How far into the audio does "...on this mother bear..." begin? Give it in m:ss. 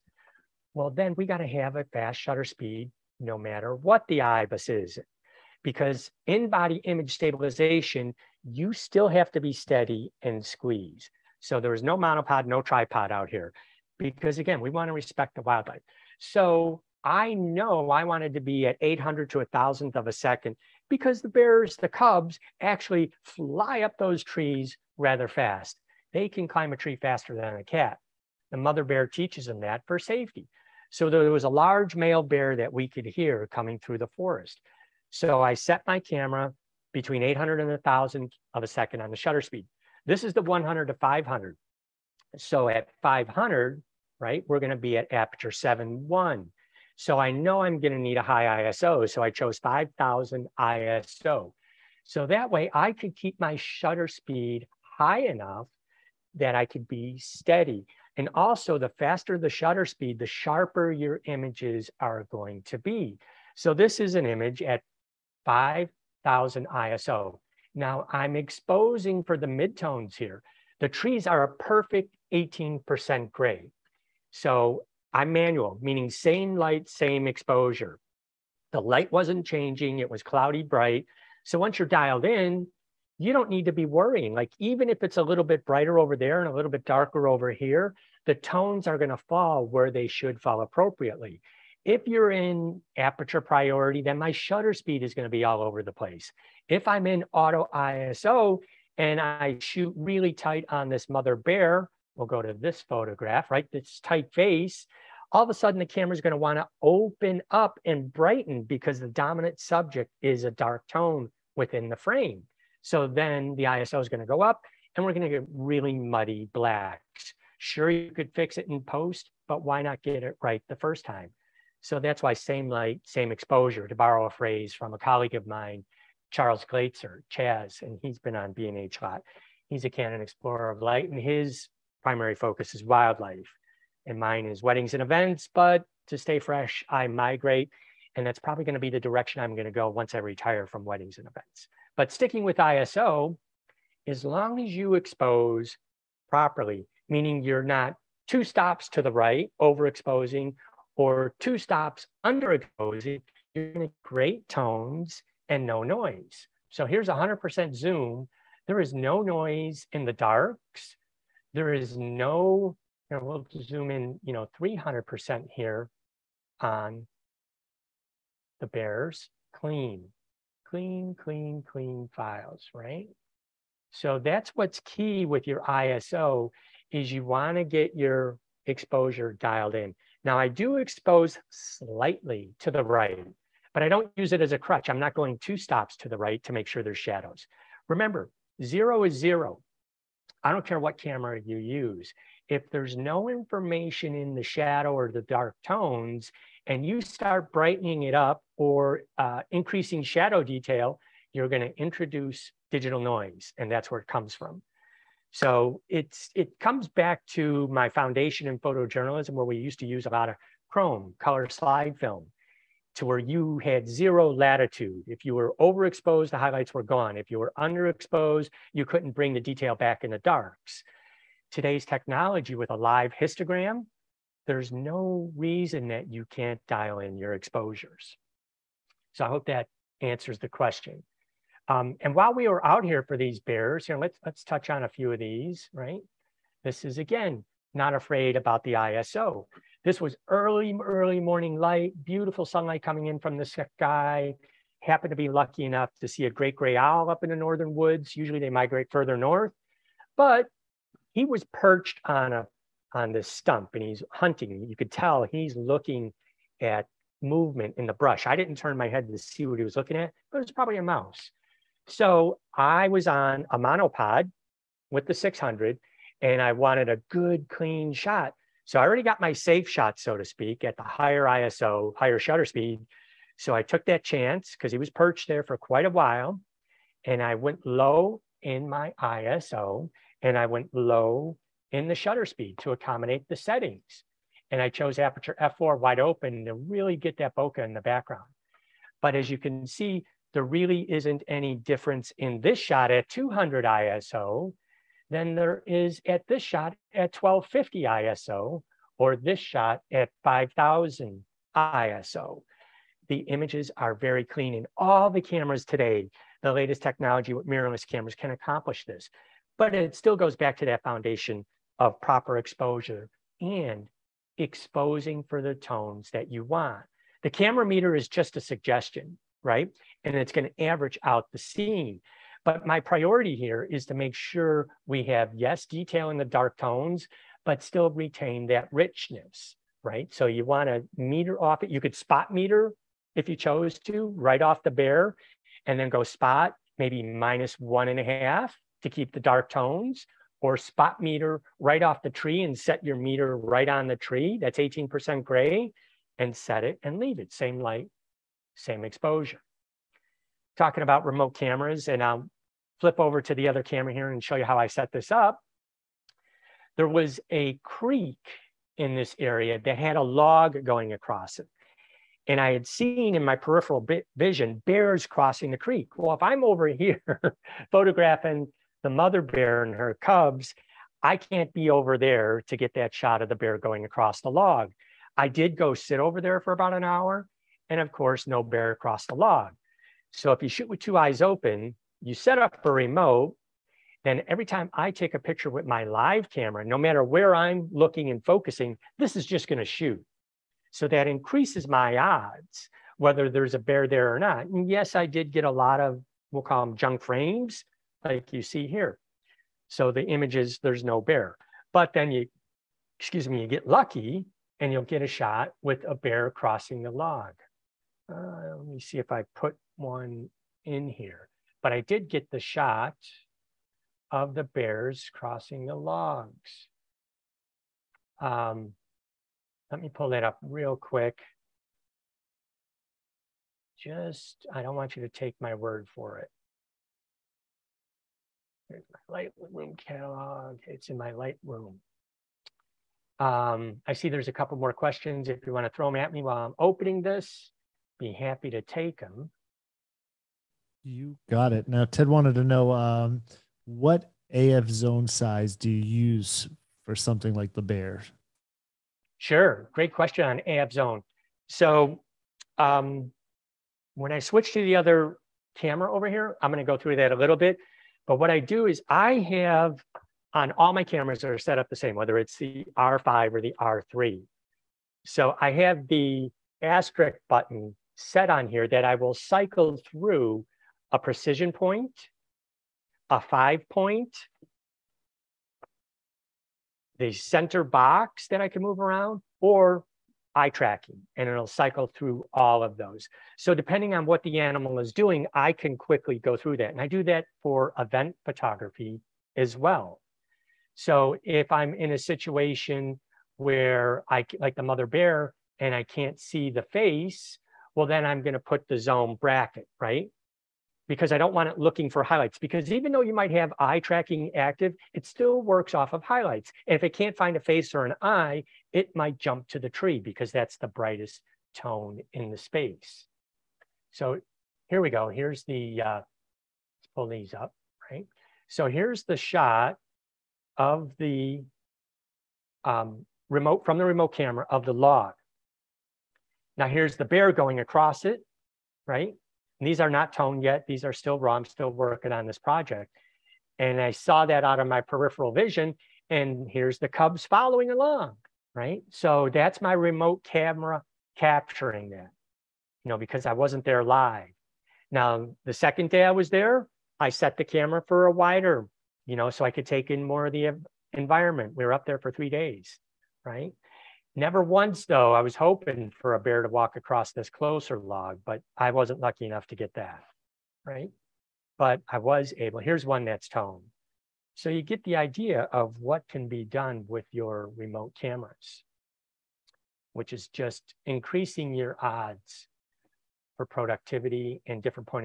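1:40.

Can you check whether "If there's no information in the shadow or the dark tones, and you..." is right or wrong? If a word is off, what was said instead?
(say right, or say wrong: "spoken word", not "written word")
right.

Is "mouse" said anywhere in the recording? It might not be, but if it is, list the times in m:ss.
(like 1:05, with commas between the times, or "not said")
4:20.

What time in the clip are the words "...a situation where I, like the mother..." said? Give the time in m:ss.
8:11.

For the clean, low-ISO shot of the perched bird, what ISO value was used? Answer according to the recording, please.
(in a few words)
200.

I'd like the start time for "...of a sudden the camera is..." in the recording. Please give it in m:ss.
1:45.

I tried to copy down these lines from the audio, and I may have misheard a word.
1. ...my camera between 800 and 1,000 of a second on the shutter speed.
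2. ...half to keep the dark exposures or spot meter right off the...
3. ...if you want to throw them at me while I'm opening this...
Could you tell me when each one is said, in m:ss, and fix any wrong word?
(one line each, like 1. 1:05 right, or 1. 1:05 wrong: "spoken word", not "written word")
1. 0:35 right
2. 5:38 wrong: "tones", not "exposures"
3. 7:15 right.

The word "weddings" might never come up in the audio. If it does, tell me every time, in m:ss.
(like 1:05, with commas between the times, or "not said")
2:14, 2:20.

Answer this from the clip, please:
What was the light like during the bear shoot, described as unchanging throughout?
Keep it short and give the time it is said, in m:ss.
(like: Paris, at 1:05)
cloudy bright, at 1:20.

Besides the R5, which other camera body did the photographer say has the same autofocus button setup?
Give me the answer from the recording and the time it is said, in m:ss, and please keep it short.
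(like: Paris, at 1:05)
R3, at 7:43.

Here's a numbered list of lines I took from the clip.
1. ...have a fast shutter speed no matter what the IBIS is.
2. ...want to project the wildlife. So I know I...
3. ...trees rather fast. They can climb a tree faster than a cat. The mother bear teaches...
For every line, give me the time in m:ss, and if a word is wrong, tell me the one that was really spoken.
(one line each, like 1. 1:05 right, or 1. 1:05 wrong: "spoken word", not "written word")
1. 0:01 right
2. 0:14 wrong: "respect", not "project"
3. 0:24 right.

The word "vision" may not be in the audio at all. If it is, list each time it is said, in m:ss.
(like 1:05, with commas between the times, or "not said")
6:04, 8:55.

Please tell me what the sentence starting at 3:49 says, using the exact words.
So I hope that answers the question.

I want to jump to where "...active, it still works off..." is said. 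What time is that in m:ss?
8:24.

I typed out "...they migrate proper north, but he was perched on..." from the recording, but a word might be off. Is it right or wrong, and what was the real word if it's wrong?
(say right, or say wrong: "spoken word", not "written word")
wrong: "further", not "proper".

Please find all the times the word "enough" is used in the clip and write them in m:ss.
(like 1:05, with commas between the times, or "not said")
0:55, 4:05, 9:19.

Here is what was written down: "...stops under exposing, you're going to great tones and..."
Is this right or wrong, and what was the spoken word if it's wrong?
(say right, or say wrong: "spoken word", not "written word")
right.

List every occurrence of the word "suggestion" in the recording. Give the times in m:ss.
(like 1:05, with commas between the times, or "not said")
5:18.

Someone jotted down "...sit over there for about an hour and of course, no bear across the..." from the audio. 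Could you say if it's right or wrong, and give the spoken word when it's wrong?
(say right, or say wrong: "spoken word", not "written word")
right.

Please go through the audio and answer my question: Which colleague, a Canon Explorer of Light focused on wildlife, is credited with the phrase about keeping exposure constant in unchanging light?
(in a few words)
Charles Glatzer.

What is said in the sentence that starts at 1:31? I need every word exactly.
If you're in aperture priority, then my shutter speed is going to be all over the place.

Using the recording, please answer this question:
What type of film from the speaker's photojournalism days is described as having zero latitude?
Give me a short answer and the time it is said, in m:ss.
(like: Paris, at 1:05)
color slide film, at 3:31.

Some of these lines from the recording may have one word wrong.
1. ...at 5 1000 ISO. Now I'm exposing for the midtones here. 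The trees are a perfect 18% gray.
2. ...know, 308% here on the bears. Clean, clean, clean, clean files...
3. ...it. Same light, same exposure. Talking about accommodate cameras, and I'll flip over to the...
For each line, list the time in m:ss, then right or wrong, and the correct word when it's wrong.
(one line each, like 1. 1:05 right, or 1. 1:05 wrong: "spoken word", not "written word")
1. 1:04 right
2. 2:44 wrong: "300", not "308"
3. 5:47 wrong: "remote", not "accommodate".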